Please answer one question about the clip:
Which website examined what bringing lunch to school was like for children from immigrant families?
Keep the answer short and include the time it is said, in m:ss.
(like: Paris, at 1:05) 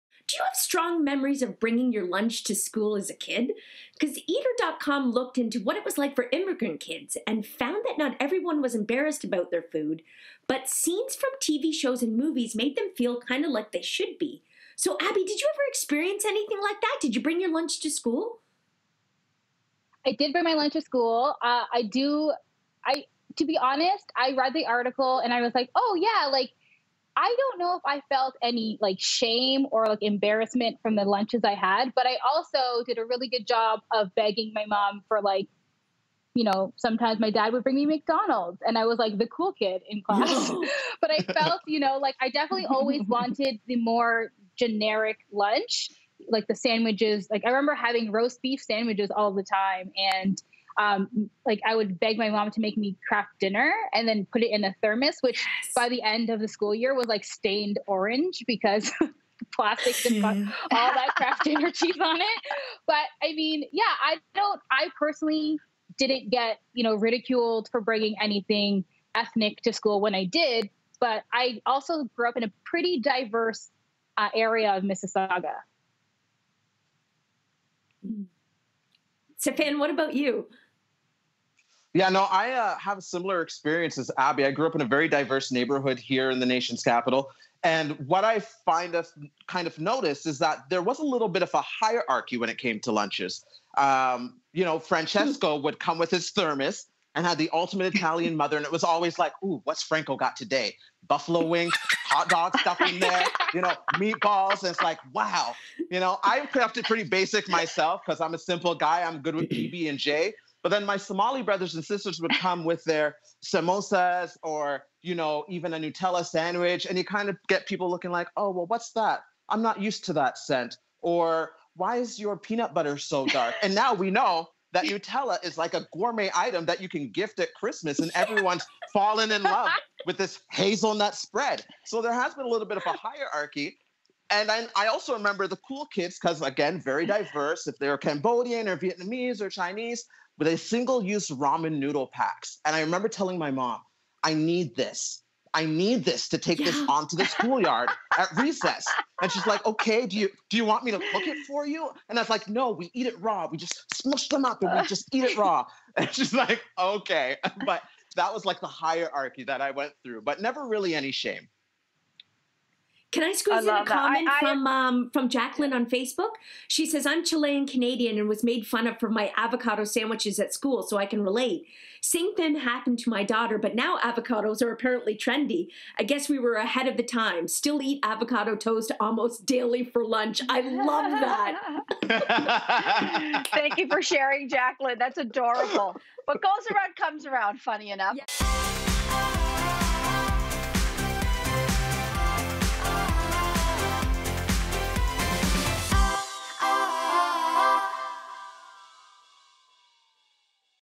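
Eater.com, at 0:04.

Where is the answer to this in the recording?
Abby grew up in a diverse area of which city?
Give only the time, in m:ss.
1:14.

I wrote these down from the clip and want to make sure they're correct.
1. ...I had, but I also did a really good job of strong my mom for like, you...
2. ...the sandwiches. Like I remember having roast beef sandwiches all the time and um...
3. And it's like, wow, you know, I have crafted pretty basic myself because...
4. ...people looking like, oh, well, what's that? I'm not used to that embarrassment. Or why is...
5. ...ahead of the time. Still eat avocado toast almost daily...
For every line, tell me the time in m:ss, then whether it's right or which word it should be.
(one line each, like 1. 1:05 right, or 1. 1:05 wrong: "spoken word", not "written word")
1. 0:31 wrong: "begging", not "strong"
2. 0:46 right
3. 1:44 right
4. 1:57 wrong: "scent", not "embarrassment"
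5. 2:56 right.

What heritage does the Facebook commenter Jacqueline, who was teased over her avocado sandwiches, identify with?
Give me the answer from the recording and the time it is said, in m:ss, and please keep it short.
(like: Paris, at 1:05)
Chilean Canadian, at 2:47.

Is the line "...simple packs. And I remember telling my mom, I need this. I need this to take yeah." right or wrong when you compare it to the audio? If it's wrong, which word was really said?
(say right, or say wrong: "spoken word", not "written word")
wrong: "noodle", not "simple".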